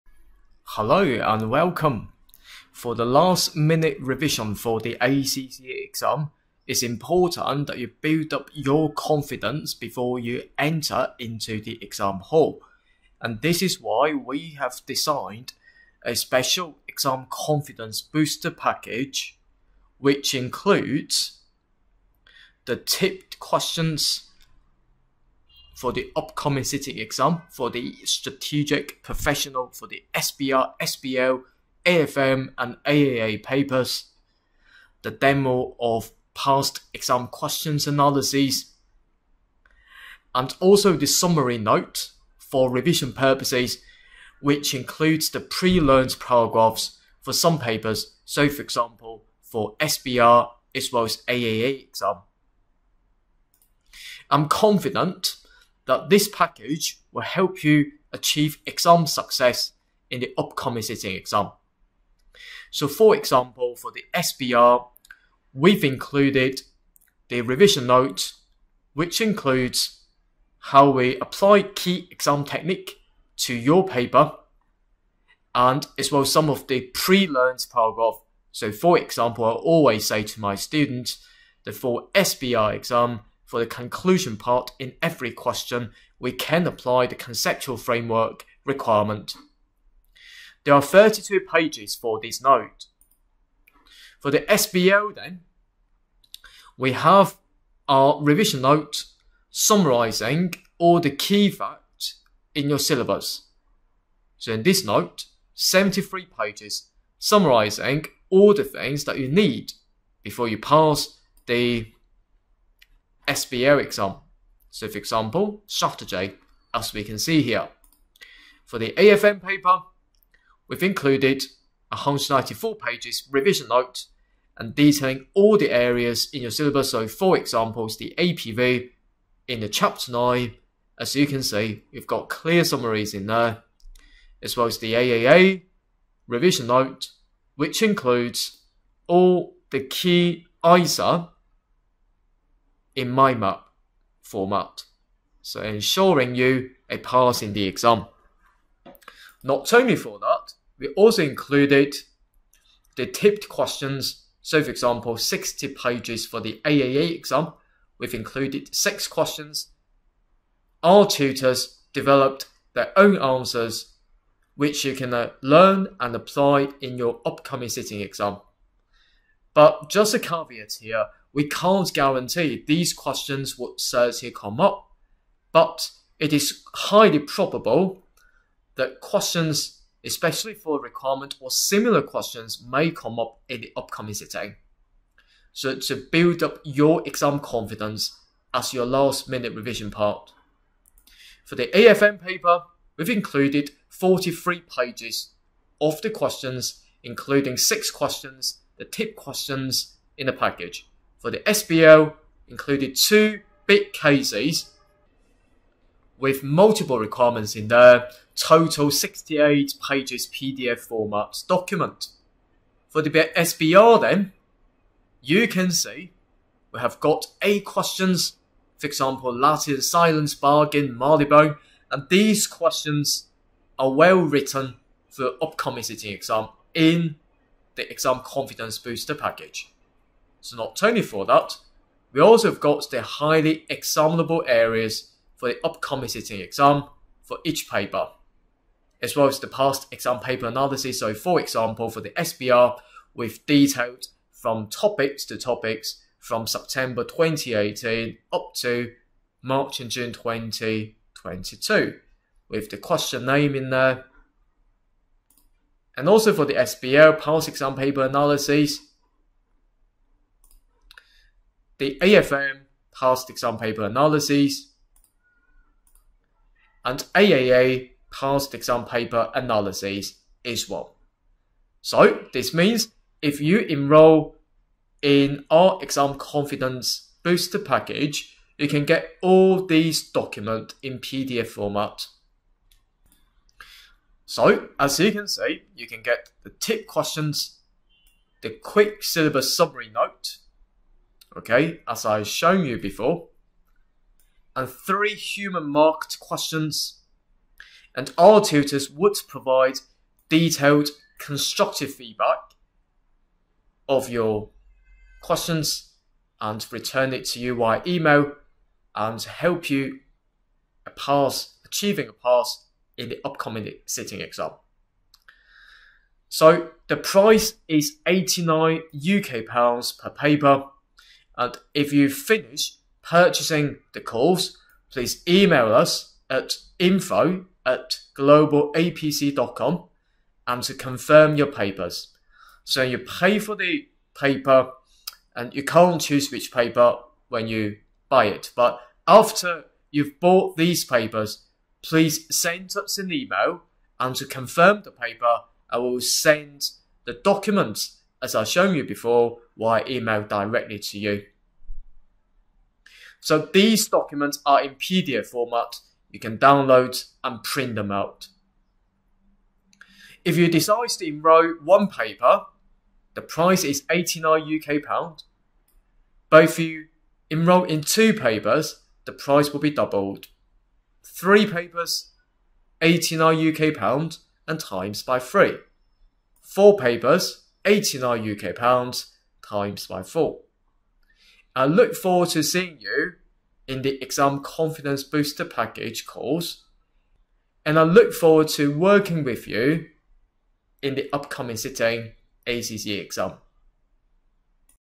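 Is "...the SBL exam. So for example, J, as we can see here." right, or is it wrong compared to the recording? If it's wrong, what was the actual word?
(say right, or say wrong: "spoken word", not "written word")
right.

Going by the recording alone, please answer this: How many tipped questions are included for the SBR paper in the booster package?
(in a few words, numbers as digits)
8.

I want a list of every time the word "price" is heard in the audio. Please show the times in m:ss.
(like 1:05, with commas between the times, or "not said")
5:16, 6:03, 6:09.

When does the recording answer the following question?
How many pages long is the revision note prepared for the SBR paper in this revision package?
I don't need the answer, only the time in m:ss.
1:30.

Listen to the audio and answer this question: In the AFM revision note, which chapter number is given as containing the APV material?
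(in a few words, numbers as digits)
9.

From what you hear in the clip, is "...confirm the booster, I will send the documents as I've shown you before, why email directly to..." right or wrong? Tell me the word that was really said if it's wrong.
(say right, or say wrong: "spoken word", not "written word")
wrong: "paper", not "booster".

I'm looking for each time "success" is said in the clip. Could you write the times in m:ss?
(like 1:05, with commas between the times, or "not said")
0:59.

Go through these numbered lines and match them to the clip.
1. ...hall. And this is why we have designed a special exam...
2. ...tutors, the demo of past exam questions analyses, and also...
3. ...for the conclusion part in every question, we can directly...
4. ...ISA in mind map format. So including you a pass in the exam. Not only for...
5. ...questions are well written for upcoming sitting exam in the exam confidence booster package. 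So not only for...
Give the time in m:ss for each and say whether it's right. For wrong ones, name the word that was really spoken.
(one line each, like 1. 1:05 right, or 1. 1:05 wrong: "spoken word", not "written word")
1. 0:12 right
2. 0:33 wrong: "papers", not "tutors"
3. 1:23 wrong: "apply", not "directly"
4. 2:20 wrong: "ensuring", not "including"
5. 3:42 right.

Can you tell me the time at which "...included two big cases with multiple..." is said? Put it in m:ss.
3:22.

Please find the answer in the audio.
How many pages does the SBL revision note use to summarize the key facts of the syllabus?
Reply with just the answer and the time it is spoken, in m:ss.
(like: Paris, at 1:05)
73, at 1:45.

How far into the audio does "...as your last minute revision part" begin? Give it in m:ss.
3:08.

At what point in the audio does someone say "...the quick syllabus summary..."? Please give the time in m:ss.
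4:48.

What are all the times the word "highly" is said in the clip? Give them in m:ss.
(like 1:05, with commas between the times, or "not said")
2:56, 3:53.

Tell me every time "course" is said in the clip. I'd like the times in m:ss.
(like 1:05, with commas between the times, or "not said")
5:24, 6:26.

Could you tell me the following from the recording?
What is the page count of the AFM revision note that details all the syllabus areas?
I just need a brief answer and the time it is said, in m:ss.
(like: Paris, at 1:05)
194, at 2:01.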